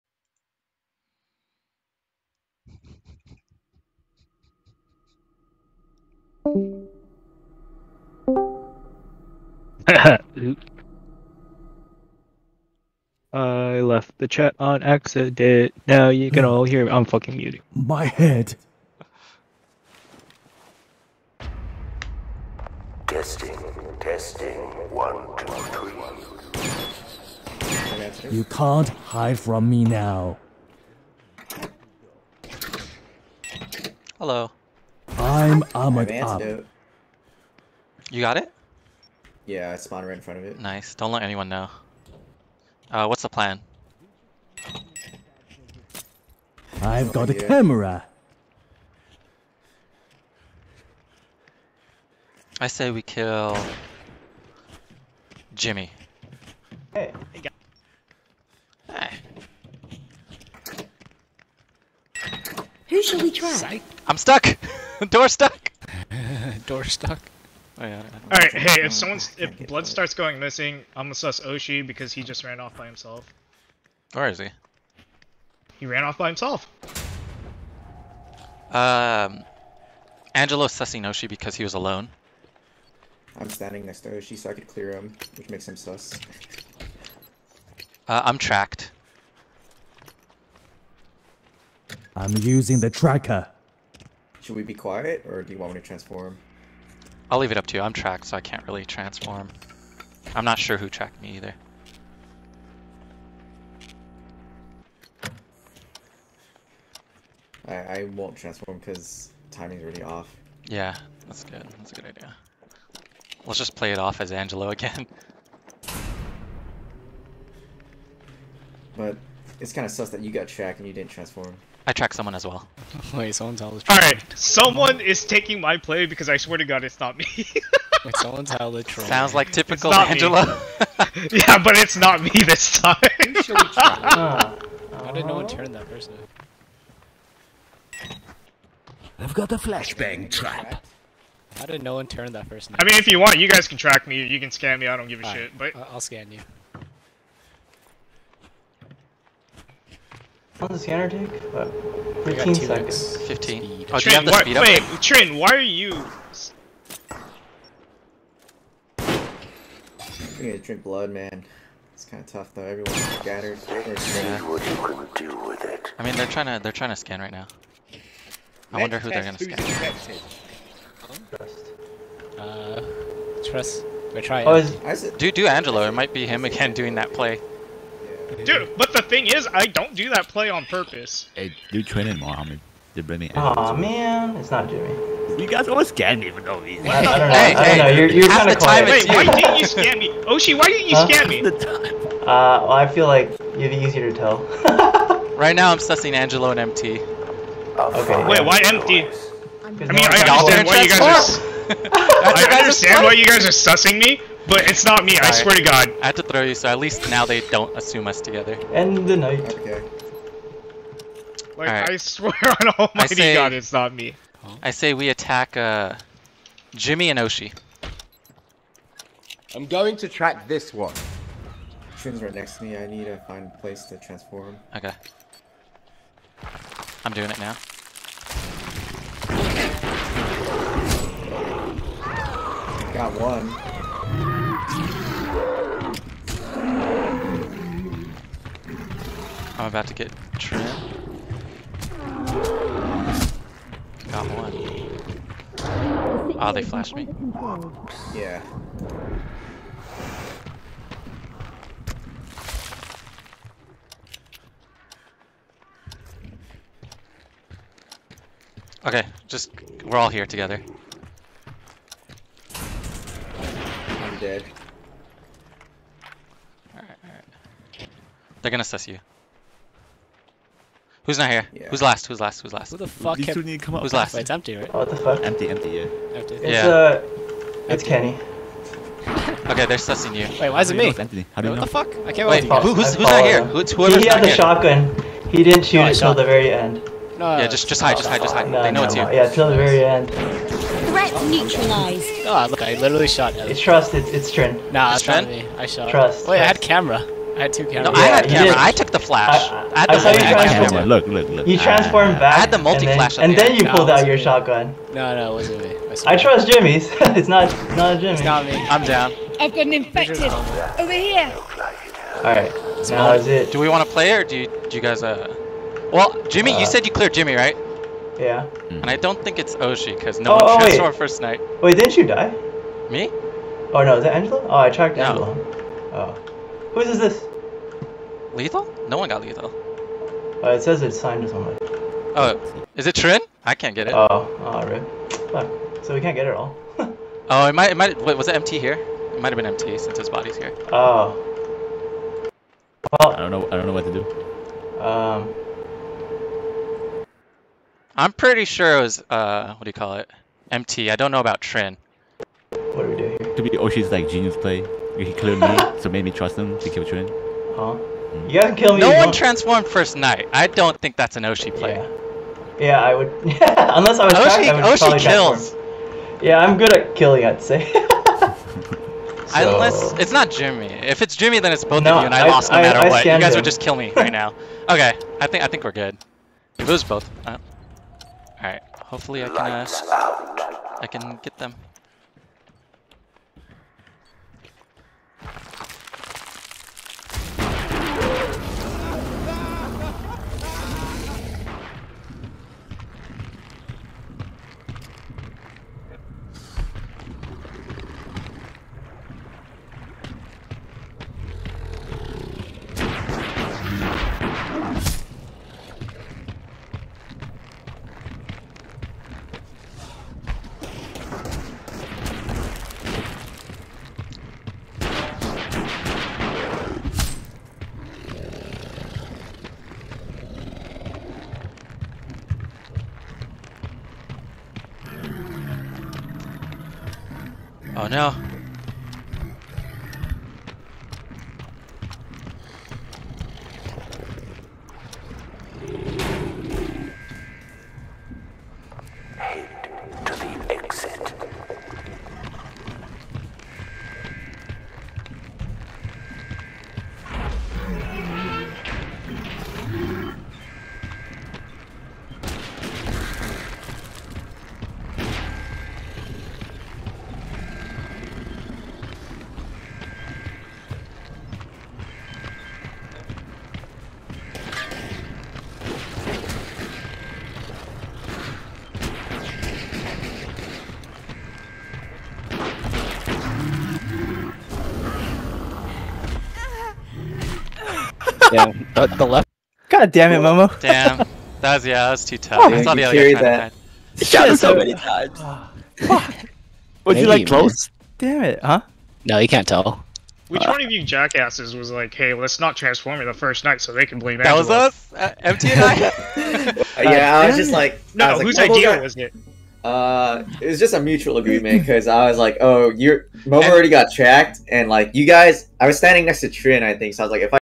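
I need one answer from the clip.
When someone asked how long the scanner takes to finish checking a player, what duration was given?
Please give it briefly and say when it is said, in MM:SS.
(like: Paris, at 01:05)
15 seconds, at 02:32.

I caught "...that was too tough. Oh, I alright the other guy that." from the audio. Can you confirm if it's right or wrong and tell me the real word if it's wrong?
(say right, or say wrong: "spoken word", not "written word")
wrong: "thought", not "alright".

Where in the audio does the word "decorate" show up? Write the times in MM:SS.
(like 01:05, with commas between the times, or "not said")
not said.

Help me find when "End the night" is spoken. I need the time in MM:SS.
03:28.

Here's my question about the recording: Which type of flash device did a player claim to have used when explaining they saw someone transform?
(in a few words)
multi-flash.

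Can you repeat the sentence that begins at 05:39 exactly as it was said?
It might have been MT since his body's here.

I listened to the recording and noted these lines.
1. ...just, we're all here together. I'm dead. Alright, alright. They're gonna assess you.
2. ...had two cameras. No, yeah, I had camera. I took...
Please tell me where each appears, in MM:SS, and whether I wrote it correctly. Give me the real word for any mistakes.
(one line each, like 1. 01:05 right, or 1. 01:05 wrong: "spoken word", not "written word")
1. 04:19 right
2. 04:57 right.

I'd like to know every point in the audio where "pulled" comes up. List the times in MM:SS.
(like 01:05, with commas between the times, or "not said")
05:03.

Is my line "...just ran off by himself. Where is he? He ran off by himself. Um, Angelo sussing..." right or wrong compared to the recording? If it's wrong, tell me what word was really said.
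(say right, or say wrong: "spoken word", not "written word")
right.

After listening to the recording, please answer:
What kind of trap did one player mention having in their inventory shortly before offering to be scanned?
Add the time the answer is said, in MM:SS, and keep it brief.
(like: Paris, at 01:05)
flashbang trap, at 02:19.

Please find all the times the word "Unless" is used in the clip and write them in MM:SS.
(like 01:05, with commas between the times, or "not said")
06:03, 06:09.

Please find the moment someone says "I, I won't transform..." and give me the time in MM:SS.
01:47.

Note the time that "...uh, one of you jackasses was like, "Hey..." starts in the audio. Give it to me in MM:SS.
08:10.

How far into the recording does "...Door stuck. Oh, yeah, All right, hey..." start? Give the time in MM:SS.
01:06.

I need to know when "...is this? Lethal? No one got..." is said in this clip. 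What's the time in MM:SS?
05:26.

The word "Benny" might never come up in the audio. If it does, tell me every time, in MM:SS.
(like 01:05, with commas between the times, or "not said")
03:03.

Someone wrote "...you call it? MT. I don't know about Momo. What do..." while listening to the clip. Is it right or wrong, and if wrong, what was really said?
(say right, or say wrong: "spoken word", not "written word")
wrong: "Trin", not "Momo".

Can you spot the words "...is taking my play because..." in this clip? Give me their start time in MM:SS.
02:05.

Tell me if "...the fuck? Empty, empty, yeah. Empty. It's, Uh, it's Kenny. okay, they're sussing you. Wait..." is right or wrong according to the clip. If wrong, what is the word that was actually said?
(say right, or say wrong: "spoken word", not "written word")
right.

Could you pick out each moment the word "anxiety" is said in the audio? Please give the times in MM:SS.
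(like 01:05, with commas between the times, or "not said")
not said.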